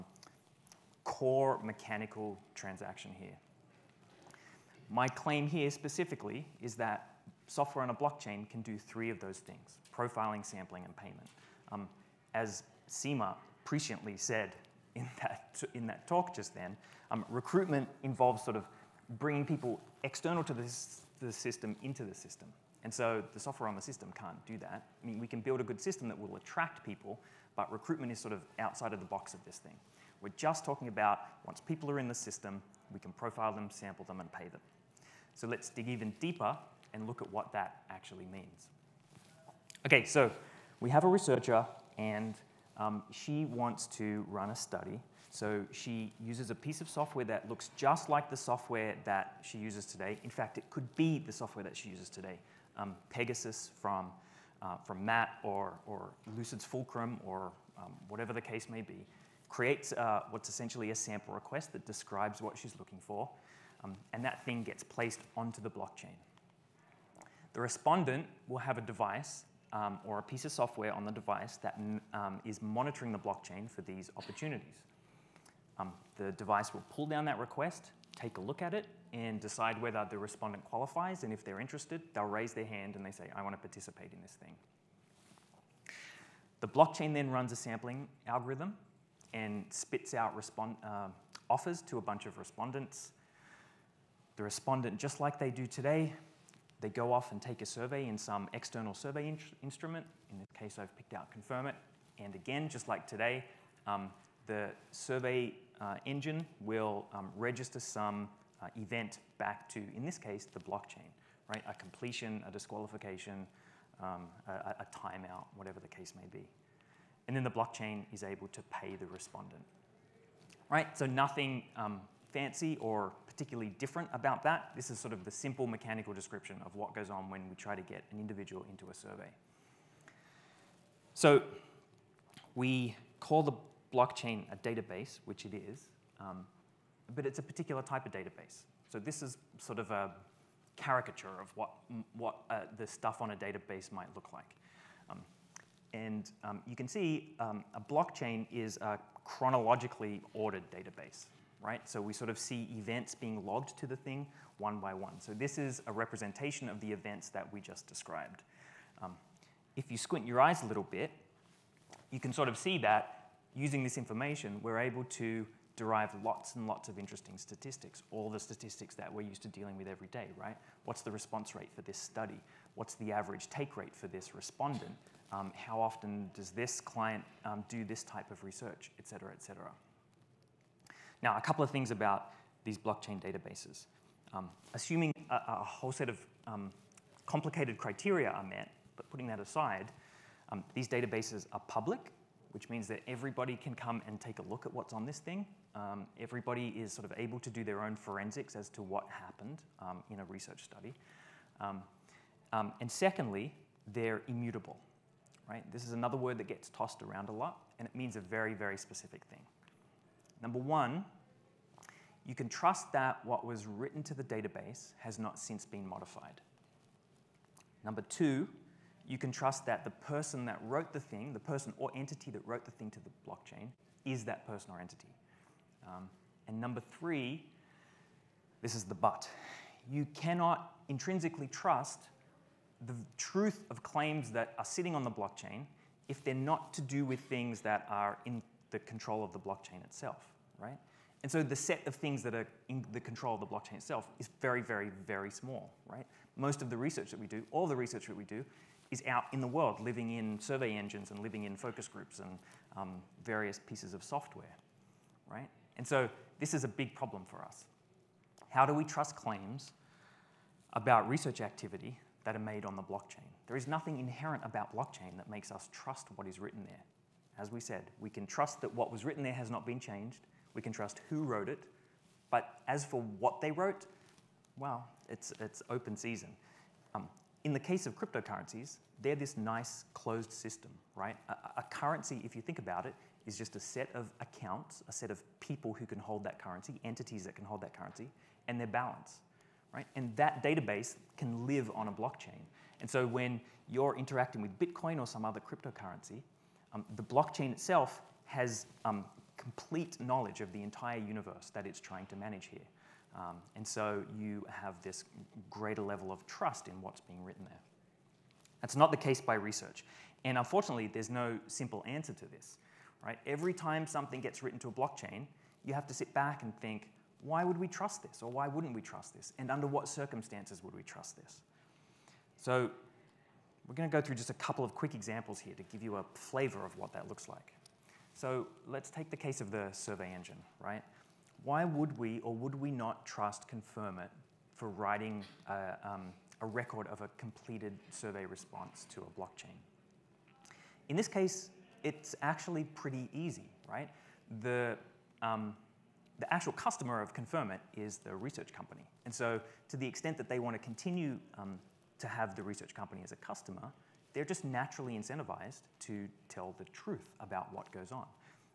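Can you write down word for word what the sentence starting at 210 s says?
Number one, you can trust that what was written to the database has not since been modified.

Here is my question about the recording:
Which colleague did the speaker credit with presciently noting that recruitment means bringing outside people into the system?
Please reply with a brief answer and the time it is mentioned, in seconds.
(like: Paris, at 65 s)
Seema, at 12 s.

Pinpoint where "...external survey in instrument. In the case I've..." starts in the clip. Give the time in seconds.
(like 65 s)
98 s.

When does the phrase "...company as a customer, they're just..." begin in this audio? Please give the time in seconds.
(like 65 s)
352 s.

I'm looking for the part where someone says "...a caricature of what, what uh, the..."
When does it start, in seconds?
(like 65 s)
139 s.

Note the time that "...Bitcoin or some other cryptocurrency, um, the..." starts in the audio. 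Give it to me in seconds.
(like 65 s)
294 s.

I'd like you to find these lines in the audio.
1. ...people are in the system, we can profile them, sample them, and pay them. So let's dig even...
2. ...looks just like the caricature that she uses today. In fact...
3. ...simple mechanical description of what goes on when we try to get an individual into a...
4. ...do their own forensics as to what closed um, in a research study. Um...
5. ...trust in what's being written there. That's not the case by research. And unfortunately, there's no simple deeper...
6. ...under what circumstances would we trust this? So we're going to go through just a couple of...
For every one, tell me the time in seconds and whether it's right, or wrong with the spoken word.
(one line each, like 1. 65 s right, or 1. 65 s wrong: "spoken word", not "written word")
1. 31 s right
2. 47 s wrong: "software", not "caricature"
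3. 125 s right
4. 197 s wrong: "happened", not "closed"
5. 306 s wrong: "answer", not "deeper"
6. 319 s right.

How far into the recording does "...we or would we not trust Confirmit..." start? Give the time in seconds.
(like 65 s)
331 s.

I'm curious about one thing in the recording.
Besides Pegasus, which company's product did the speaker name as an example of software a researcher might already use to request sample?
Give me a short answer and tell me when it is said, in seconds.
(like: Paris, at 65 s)
Lucid's Fulcrum, at 56 s.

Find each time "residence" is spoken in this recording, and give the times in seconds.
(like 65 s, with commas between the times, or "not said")
not said.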